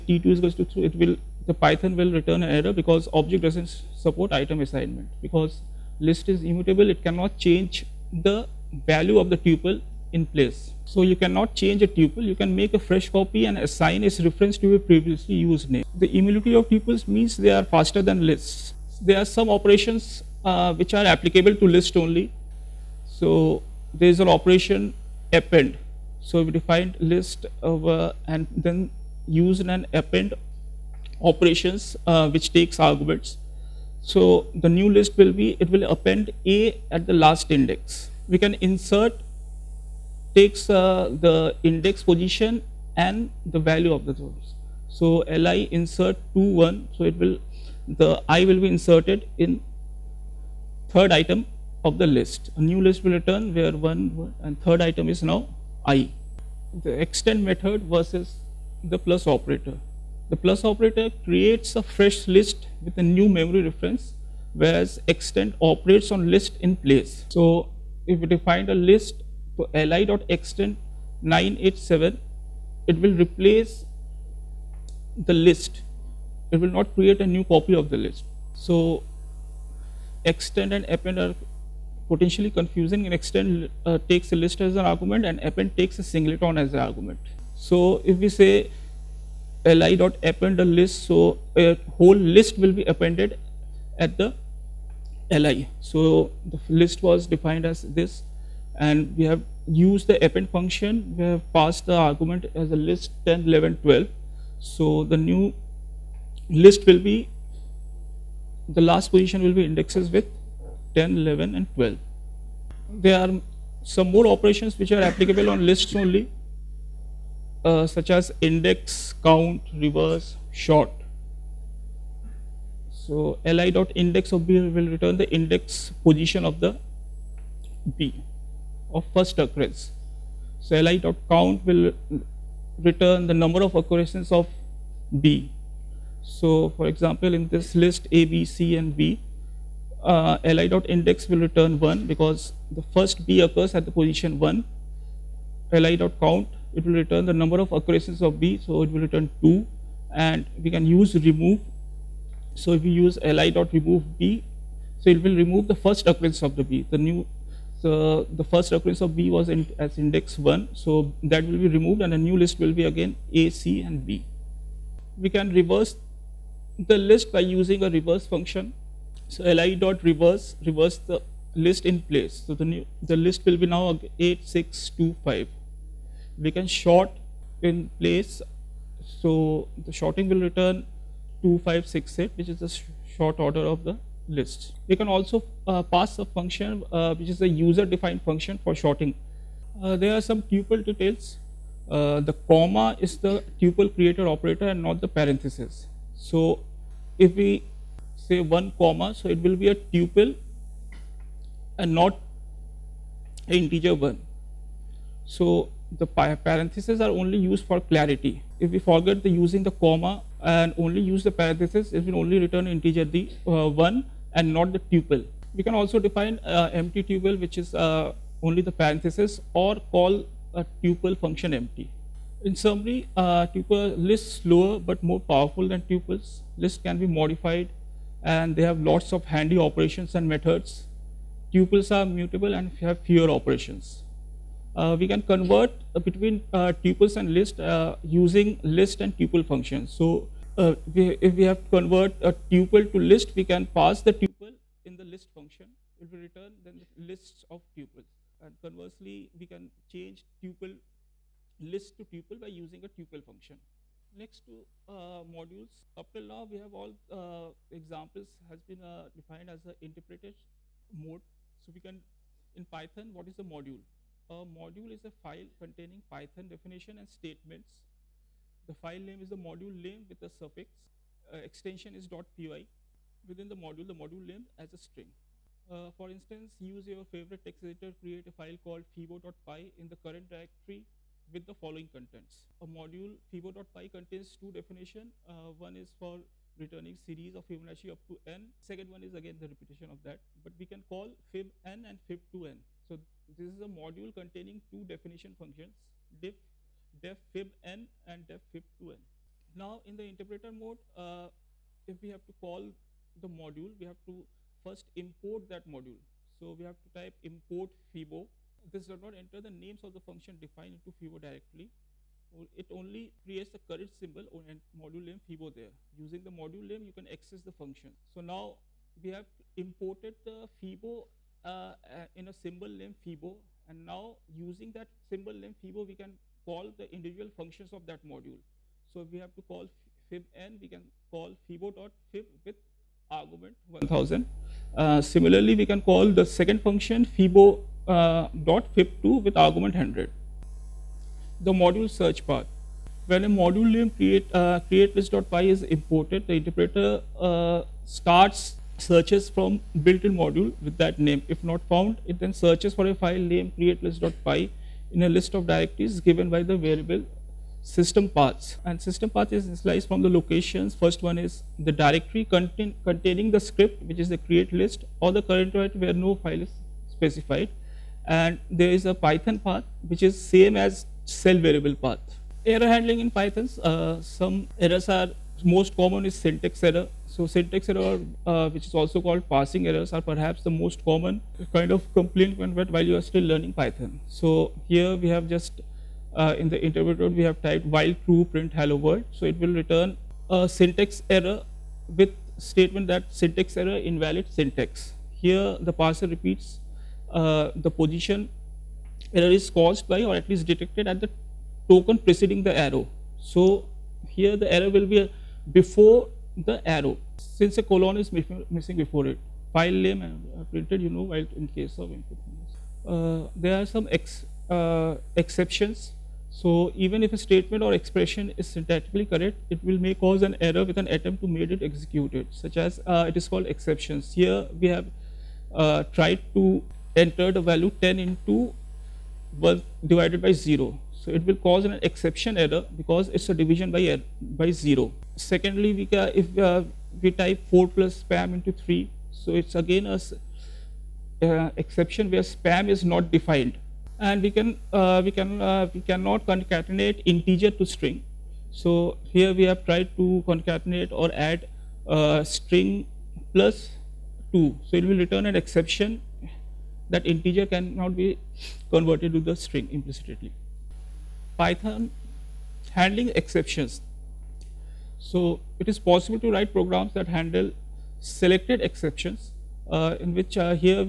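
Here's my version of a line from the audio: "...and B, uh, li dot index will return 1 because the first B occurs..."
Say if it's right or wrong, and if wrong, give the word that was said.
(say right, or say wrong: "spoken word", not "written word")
right.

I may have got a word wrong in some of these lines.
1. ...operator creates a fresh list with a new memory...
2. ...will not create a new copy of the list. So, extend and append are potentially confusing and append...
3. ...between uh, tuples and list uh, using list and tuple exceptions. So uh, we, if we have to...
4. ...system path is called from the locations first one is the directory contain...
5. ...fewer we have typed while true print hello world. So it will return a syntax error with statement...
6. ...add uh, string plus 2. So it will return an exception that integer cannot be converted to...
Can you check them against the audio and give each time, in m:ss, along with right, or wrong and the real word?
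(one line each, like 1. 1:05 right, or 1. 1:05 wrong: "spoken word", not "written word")
1. 1:00 right
2. 1:16 wrong: "extend", not "append"
3. 3:55 wrong: "functions", not "exceptions"
4. 5:58 wrong: "initialized", not "called"
5. 6:26 wrong: "interpreter", not "fewer"
6. 7:31 right.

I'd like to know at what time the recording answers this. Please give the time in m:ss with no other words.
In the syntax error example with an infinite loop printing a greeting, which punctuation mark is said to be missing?
6:47.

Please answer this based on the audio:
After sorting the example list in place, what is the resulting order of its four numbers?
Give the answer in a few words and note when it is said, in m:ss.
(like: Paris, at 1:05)
2, 5, 6, 8, at 3:01.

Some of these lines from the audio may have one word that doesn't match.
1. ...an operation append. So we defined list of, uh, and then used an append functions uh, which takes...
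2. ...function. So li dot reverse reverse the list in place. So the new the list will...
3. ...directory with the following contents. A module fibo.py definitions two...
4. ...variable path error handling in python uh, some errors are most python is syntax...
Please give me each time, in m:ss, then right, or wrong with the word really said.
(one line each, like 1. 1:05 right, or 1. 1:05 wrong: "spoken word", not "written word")
1. 0:24 wrong: "operations", not "functions"
2. 2:48 right
3. 4:40 wrong: "contains", not "definitions"
4. 6:11 wrong: "common", not "python".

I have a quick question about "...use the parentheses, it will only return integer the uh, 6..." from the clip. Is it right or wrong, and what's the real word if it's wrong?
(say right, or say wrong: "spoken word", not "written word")
wrong: "1", not "6".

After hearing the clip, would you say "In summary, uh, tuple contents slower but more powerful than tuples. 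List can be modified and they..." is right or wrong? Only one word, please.
wrong.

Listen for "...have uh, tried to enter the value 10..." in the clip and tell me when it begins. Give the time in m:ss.
7:04.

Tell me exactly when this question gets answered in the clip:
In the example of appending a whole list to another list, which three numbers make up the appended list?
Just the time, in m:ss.
1:43.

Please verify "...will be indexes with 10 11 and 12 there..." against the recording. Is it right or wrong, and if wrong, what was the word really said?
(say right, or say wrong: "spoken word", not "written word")
right.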